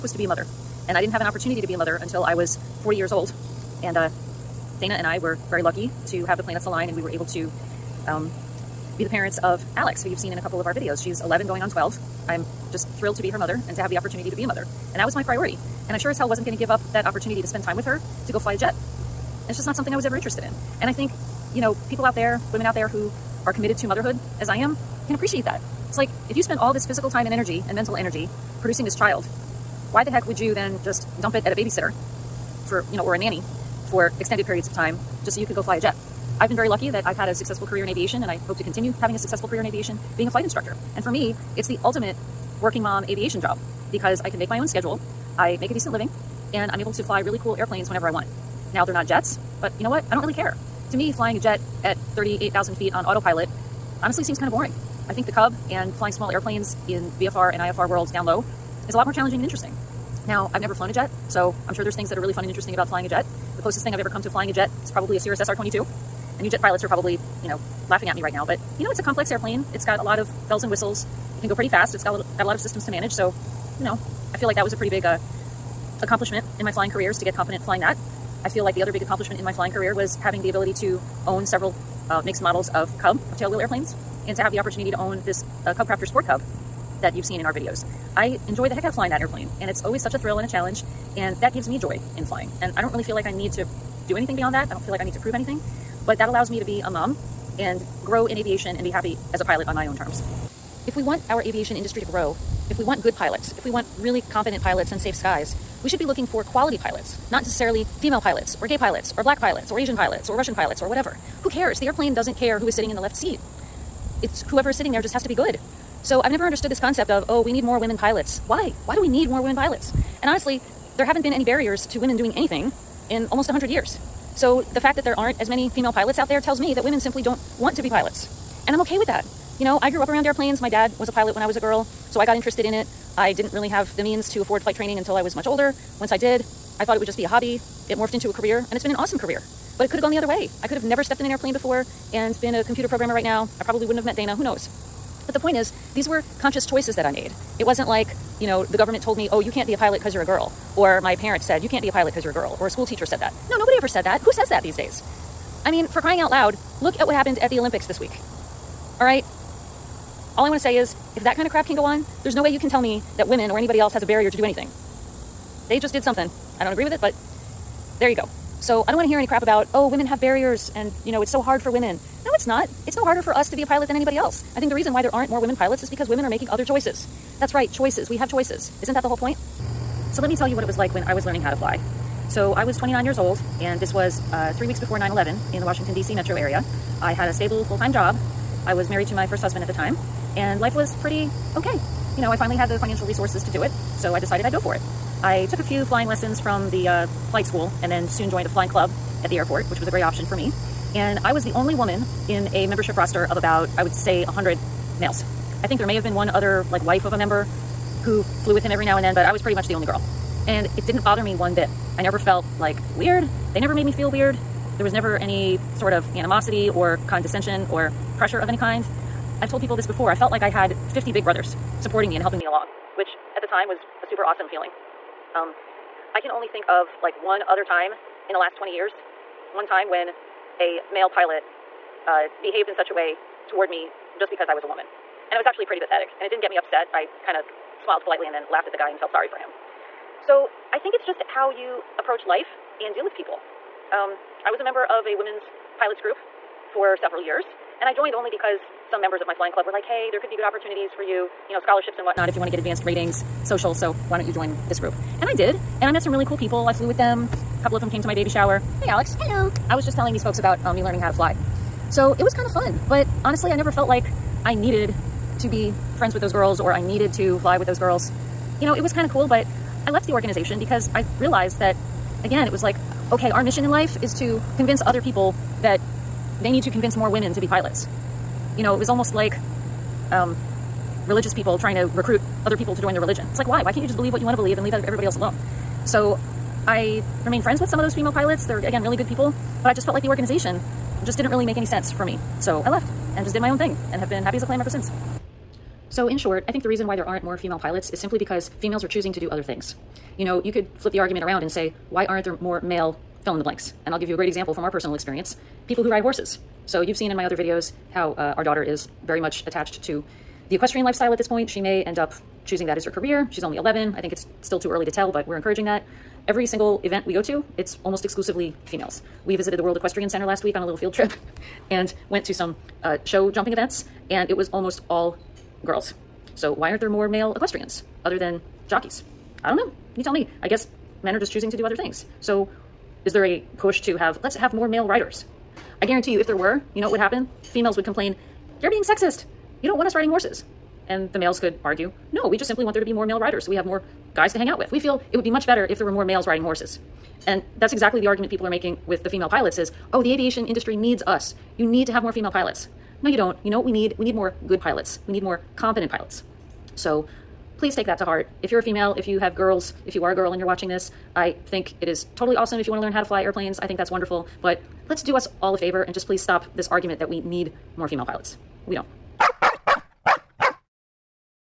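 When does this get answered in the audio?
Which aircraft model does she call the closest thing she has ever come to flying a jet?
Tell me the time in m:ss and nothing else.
1:05.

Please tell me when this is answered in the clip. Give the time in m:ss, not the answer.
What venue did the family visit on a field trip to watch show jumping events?
5:19.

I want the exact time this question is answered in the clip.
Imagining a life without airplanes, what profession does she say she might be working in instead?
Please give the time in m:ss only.
2:22.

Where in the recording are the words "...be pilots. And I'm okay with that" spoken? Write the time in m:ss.
2:07.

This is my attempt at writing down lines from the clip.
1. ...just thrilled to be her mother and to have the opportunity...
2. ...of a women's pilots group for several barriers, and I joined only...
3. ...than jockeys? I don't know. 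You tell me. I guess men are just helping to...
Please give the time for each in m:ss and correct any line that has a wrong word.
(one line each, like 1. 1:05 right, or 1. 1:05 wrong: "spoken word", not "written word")
1. 0:12 right
2. 4:04 wrong: "years", not "barriers"
3. 5:28 wrong: "choosing", not "helping".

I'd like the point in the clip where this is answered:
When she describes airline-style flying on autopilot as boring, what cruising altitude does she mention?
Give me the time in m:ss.
0:51.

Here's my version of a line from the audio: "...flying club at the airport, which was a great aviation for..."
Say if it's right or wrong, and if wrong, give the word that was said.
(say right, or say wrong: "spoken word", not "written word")
wrong: "option", not "aviation".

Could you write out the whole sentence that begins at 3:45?
Um, I can only think of like one other time in the last 20 years.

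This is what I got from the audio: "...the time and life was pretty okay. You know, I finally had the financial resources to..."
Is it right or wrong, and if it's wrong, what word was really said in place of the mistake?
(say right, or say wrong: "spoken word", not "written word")
right.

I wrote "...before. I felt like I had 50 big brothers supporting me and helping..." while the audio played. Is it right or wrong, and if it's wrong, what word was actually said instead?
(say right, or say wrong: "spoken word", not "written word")
right.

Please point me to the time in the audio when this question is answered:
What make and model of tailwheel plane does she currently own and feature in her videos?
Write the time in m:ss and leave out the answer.
1:25.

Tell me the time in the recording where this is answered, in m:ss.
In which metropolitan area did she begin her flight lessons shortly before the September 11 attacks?
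3:05.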